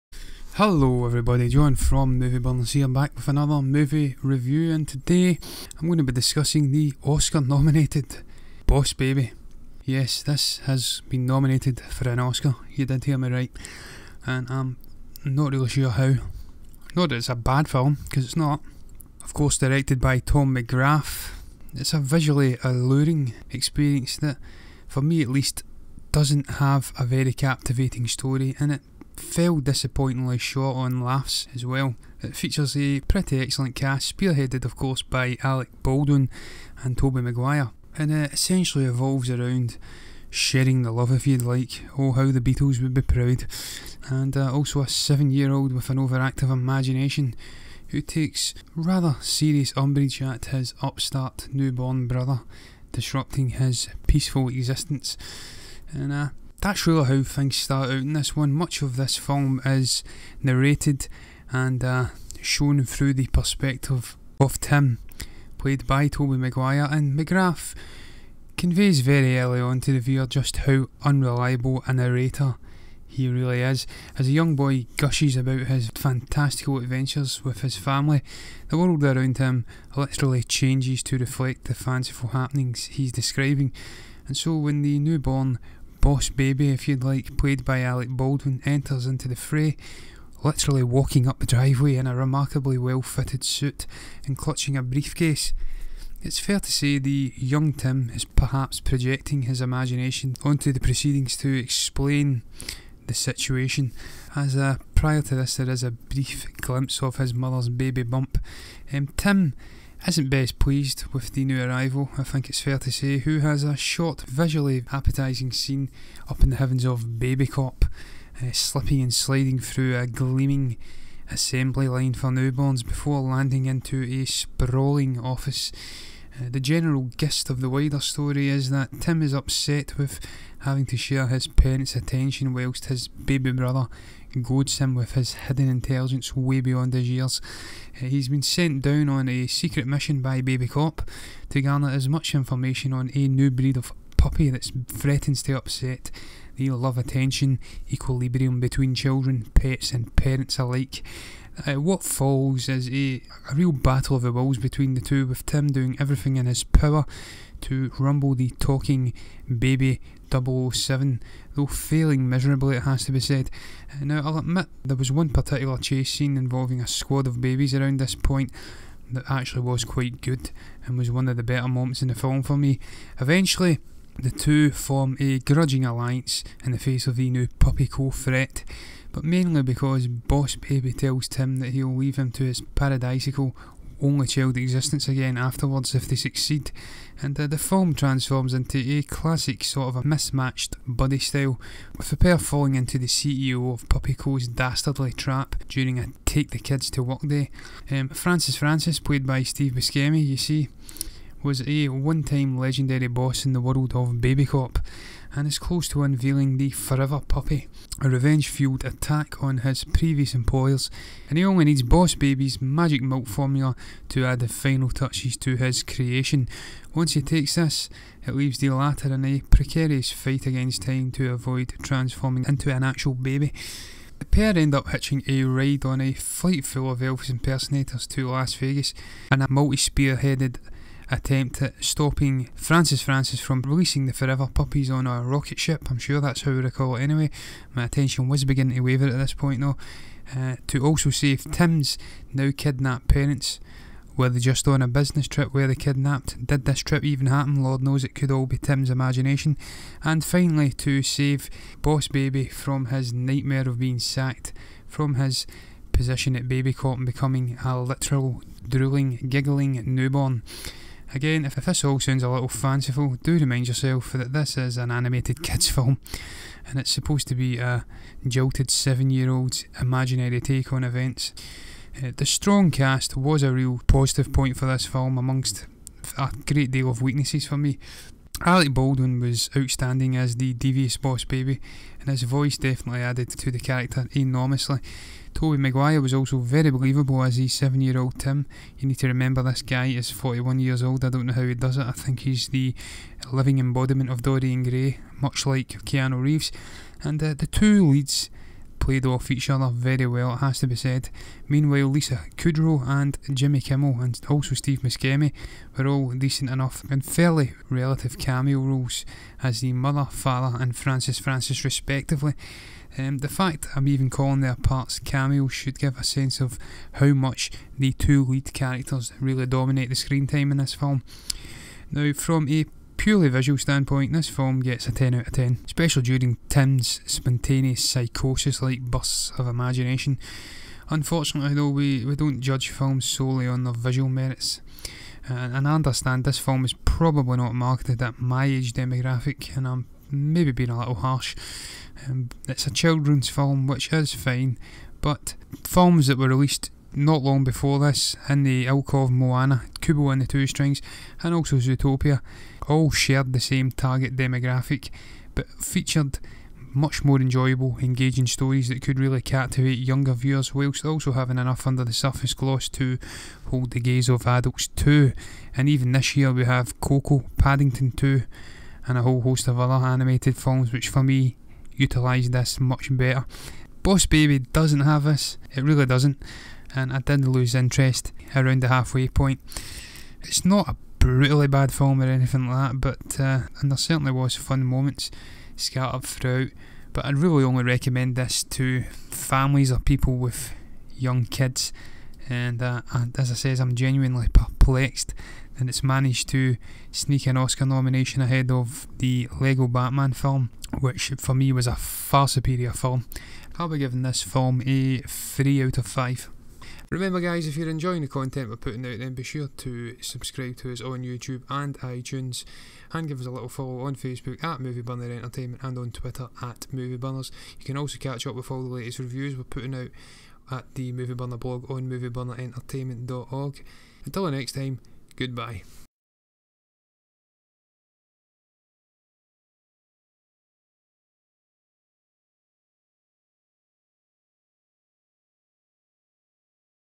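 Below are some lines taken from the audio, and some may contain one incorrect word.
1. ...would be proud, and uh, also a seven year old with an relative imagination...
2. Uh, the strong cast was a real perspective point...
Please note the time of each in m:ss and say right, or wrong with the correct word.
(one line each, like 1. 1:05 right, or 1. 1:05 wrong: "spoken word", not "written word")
1. 0:42 wrong: "overactive", not "relative"
2. 4:32 wrong: "positive", not "perspective".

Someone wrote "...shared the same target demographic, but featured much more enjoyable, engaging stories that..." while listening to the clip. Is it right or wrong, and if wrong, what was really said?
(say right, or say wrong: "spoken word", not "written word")
right.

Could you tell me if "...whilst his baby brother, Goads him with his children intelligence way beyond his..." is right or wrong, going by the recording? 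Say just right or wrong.
wrong.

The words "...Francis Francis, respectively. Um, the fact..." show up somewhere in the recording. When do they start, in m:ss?
5:10.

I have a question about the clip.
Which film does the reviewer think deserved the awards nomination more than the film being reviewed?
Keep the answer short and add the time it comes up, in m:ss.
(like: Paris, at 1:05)
The Lego Batman film, at 6:39.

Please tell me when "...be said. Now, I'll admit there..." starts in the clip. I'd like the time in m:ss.
2:43.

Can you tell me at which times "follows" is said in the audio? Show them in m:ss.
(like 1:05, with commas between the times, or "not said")
2:32, 6:53.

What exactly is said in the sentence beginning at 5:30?
Unfortunately, though, we, we don't judge films solely on their visual merits.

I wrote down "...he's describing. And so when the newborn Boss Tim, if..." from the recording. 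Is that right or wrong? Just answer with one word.
wrong.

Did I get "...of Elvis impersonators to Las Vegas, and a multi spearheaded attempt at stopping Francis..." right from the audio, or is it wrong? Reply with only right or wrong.
right.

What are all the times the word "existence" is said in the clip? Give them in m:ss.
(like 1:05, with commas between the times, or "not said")
0:54, 3:04.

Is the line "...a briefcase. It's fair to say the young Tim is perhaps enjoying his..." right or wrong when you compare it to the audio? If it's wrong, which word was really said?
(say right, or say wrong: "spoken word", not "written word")
wrong: "projecting", not "enjoying".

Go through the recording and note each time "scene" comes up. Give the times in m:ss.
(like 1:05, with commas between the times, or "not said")
1:55, 2:46.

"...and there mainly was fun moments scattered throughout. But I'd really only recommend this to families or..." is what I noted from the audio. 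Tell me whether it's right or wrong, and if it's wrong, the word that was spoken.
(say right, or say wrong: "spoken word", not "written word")
wrong: "certainly", not "mainly".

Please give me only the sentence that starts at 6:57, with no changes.
You can also catch up with all the latest reviews we're putting out at the Movie Burner blog on movieburnerentertainment.org.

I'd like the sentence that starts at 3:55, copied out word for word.
I'm sure that's how we recall it anyway.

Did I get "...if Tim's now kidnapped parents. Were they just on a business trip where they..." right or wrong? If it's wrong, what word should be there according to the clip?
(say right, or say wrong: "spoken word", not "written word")
right.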